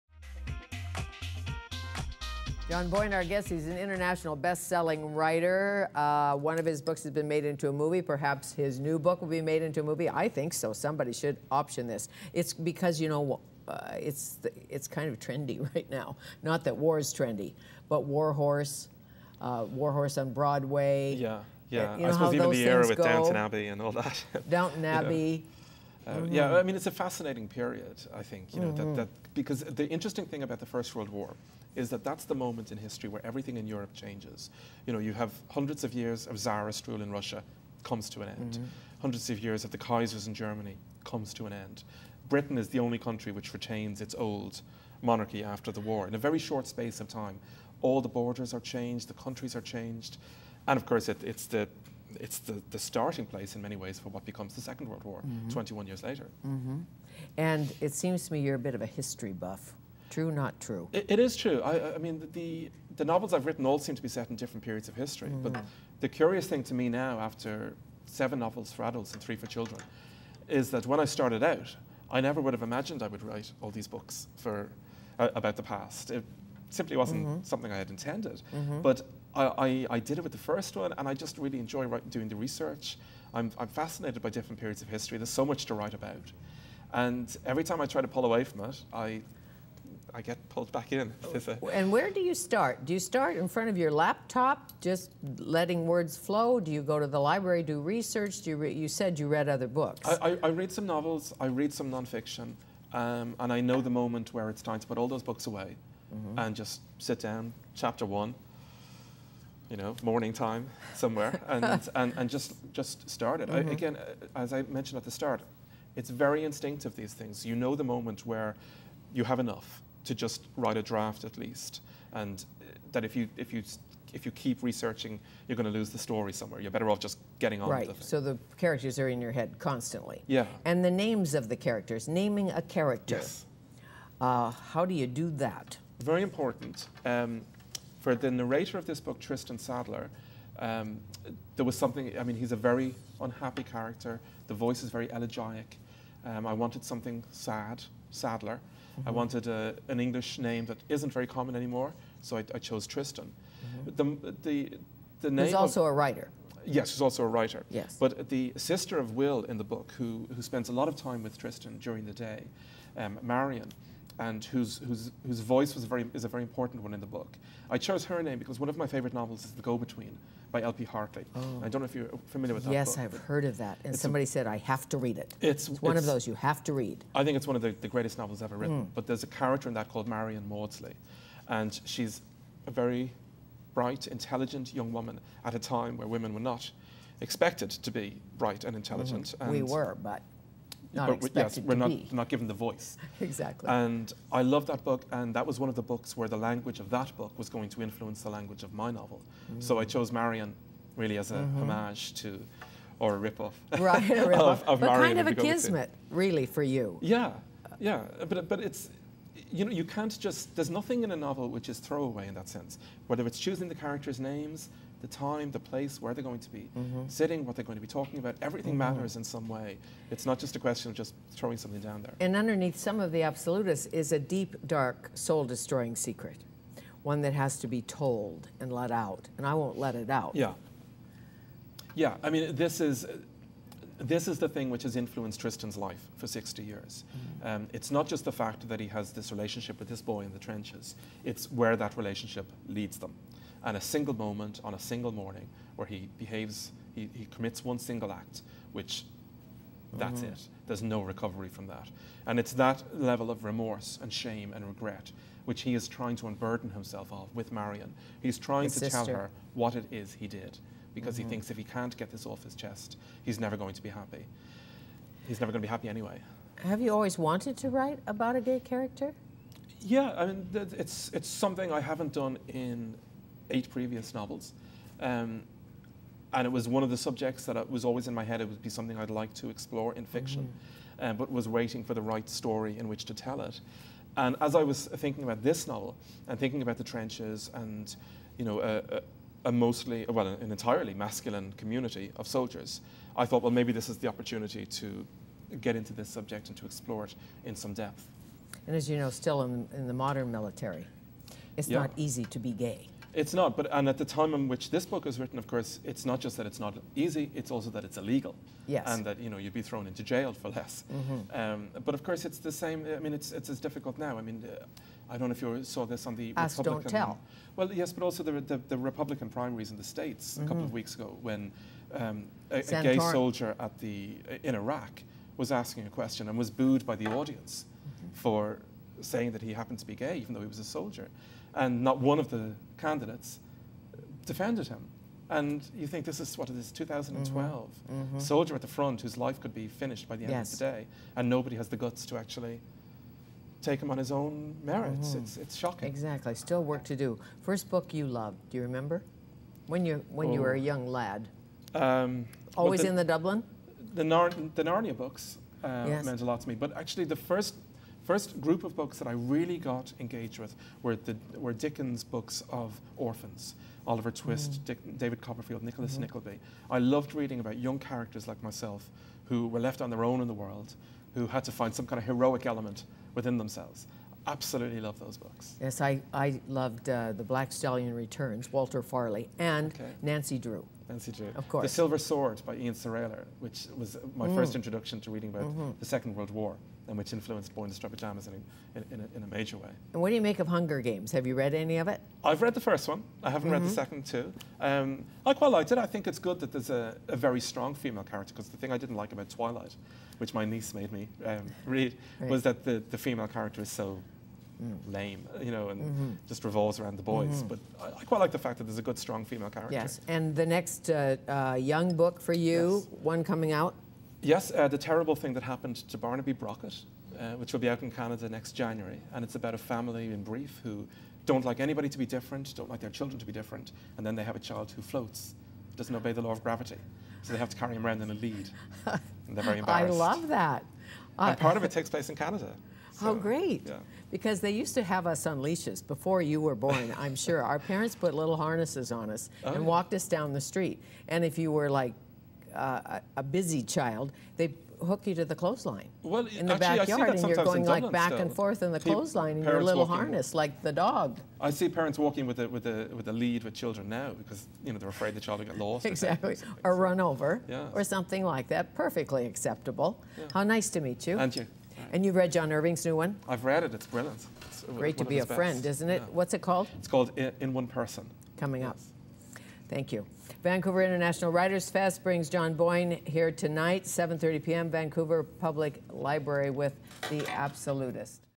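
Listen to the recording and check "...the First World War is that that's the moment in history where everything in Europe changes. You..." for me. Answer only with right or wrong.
right.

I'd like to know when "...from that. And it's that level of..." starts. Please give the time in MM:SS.
04:11.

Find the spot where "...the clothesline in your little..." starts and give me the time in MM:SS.
07:28.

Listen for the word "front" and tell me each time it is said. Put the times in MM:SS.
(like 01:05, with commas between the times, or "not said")
01:33, 05:38.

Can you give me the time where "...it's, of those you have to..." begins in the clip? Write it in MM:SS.
02:55.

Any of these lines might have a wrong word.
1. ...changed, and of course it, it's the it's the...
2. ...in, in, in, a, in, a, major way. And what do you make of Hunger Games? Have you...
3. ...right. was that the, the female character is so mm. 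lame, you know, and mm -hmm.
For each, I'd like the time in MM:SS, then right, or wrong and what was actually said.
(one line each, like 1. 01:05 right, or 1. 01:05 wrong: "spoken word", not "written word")
1. 00:49 right
2. 06:28 right
3. 06:42 right.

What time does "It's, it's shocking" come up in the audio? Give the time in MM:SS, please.
05:45.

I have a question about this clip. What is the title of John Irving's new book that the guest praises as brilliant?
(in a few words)
In One Person.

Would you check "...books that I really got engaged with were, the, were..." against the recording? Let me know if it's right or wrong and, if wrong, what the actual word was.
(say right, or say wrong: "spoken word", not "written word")
right.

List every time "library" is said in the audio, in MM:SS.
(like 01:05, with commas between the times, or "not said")
01:37, 07:55.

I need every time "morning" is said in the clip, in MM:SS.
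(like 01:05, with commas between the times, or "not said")
01:50, 04:05.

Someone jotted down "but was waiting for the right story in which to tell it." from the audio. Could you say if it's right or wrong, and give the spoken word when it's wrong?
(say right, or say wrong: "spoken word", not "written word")
right.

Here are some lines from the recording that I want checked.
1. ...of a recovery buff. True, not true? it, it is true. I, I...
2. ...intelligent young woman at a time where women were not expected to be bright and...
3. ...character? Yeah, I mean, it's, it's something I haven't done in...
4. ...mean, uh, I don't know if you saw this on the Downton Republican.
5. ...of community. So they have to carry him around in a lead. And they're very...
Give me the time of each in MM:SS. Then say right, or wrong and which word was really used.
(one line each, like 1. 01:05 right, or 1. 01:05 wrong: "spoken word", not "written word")
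1. 00:58 wrong: "history", not "recovery"
2. 03:04 right
3. 04:28 right
4. 05:14 wrong: "Ask", not "Downton"
5. 07:06 wrong: "gravity", not "community".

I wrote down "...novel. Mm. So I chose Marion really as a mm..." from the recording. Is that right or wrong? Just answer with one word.
right.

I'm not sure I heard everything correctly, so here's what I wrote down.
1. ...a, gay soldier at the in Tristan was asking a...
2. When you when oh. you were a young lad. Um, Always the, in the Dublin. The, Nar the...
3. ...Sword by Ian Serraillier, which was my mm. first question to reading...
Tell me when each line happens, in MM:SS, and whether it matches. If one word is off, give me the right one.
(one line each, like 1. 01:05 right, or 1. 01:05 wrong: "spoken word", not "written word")
1. 05:22 wrong: "Iraq", not "Tristan"
2. 05:49 right
3. 06:22 wrong: "introduction", not "question".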